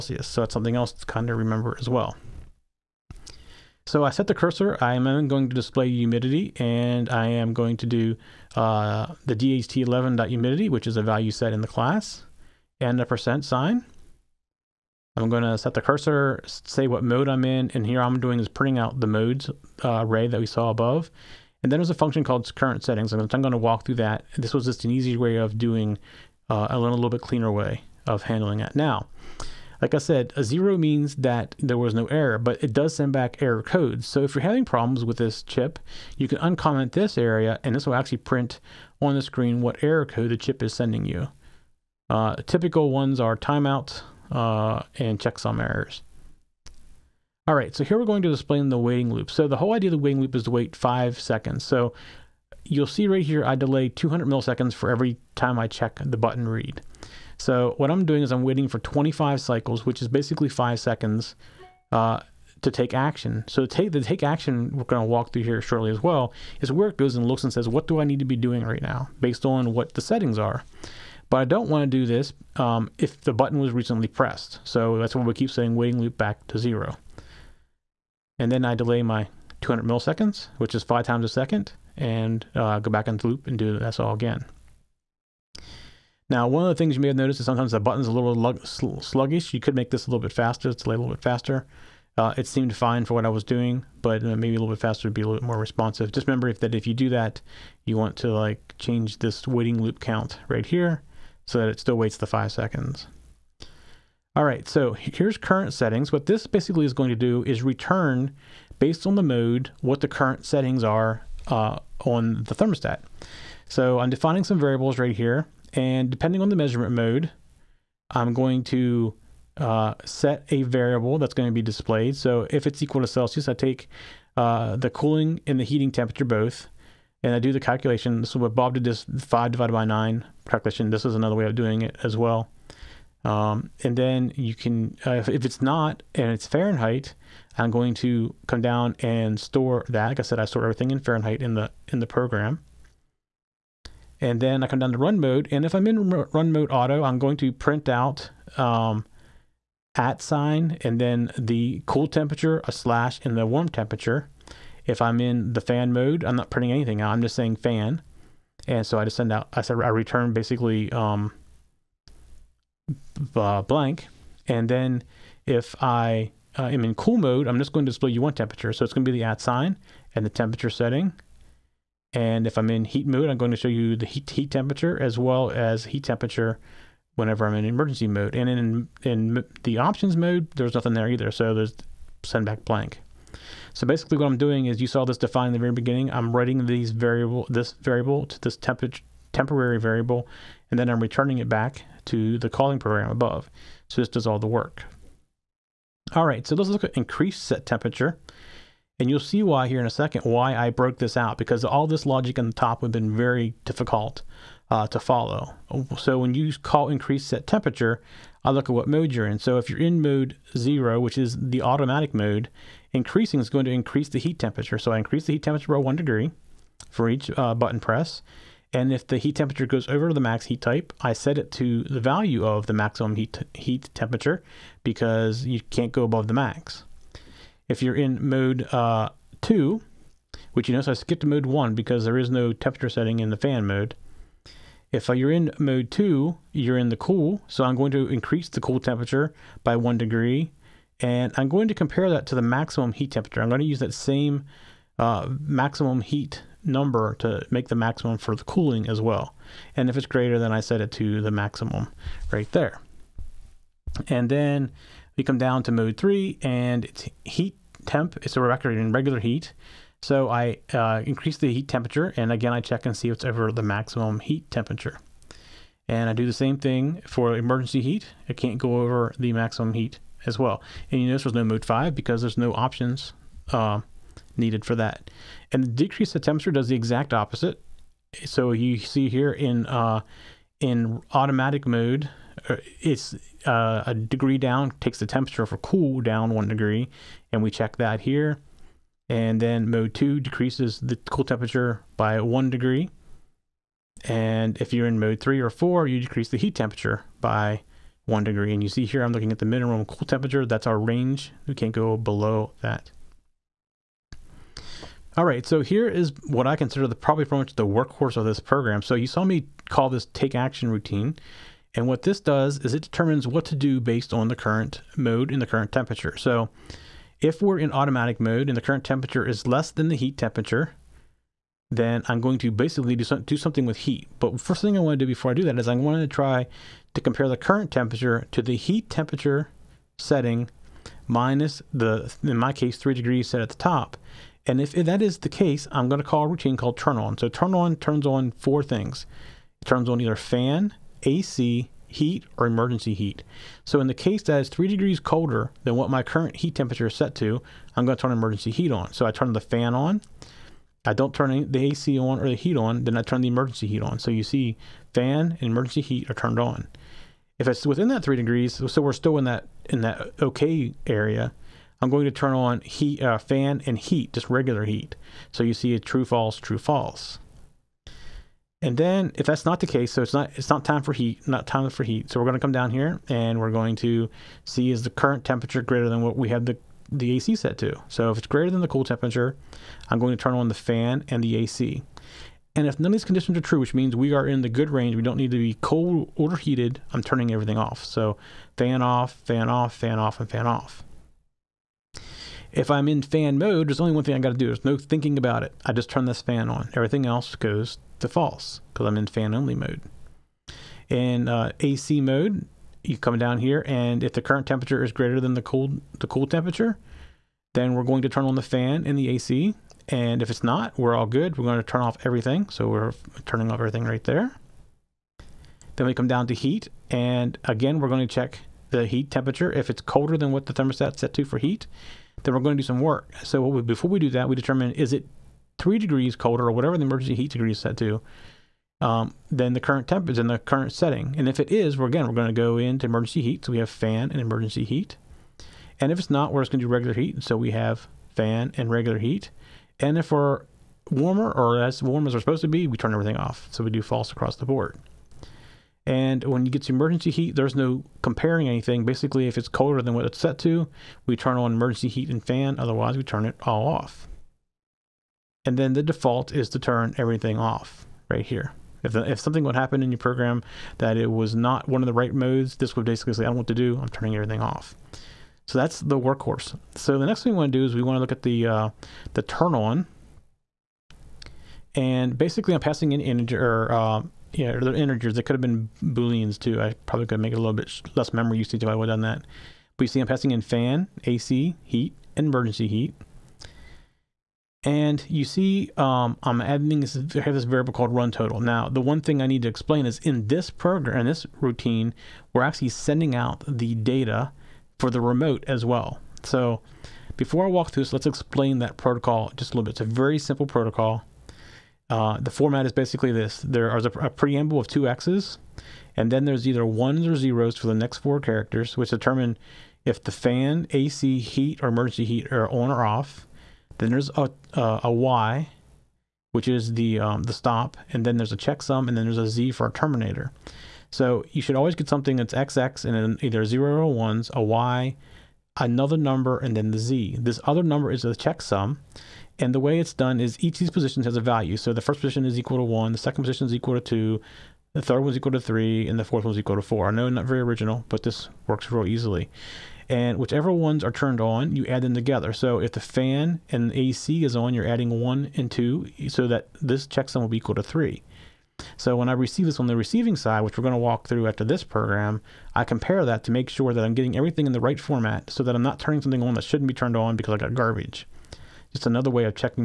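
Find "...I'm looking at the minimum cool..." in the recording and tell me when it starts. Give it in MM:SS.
04:59.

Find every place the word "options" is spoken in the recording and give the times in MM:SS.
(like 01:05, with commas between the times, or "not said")
02:59, 04:32.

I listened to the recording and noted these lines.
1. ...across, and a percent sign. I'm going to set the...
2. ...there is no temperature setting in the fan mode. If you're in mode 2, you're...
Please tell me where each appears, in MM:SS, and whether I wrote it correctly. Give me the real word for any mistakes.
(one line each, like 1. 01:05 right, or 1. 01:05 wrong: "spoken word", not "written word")
1. 00:11 wrong: "class", not "across"
2. 03:52 right.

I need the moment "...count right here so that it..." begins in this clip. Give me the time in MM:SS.
01:39.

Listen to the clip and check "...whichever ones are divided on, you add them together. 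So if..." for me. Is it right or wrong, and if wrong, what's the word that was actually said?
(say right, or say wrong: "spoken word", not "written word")
wrong: "turned", not "divided".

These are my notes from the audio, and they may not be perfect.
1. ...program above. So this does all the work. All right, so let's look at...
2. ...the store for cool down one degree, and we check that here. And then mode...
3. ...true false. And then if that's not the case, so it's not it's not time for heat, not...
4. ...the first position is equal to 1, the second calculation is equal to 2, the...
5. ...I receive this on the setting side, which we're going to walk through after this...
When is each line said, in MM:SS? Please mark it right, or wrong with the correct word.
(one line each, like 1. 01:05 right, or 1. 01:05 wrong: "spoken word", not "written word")
1. 03:12 right
2. 04:44 wrong: "temperature", not "store"
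3. 06:06 right
4. 08:51 wrong: "position", not "calculation"
5. 09:09 wrong: "receiving", not "setting".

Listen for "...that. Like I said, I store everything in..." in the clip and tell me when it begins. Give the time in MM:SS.
02:19.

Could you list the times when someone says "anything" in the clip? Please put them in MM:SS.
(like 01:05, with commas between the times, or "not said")
02:36, 07:28.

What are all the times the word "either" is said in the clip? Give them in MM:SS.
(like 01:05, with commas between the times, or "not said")
03:01, 05:40, 08:26, 08:43.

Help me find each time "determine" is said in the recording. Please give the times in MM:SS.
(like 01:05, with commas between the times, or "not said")
05:12, 07:04, 08:28.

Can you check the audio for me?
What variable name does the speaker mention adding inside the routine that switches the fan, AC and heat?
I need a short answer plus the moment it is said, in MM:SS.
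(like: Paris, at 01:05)
run total, at 08:07.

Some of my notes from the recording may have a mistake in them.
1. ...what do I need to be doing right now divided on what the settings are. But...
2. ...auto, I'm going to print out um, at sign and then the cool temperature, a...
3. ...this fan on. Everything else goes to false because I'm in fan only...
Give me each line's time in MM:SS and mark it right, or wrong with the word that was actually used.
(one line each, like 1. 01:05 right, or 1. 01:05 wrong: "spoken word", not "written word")
1. 01:07 wrong: "based", not "divided"
2. 02:26 right
3. 06:36 right.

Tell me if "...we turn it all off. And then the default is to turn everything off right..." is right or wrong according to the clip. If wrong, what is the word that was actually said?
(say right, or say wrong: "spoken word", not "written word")
right.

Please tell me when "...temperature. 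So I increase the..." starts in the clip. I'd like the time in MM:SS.
03:34.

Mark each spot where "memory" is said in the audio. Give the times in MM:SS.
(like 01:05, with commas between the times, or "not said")
07:58.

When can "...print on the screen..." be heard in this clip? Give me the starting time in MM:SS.
00:38.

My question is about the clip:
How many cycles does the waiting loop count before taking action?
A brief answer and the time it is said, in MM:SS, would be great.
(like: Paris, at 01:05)
25, at 00:58.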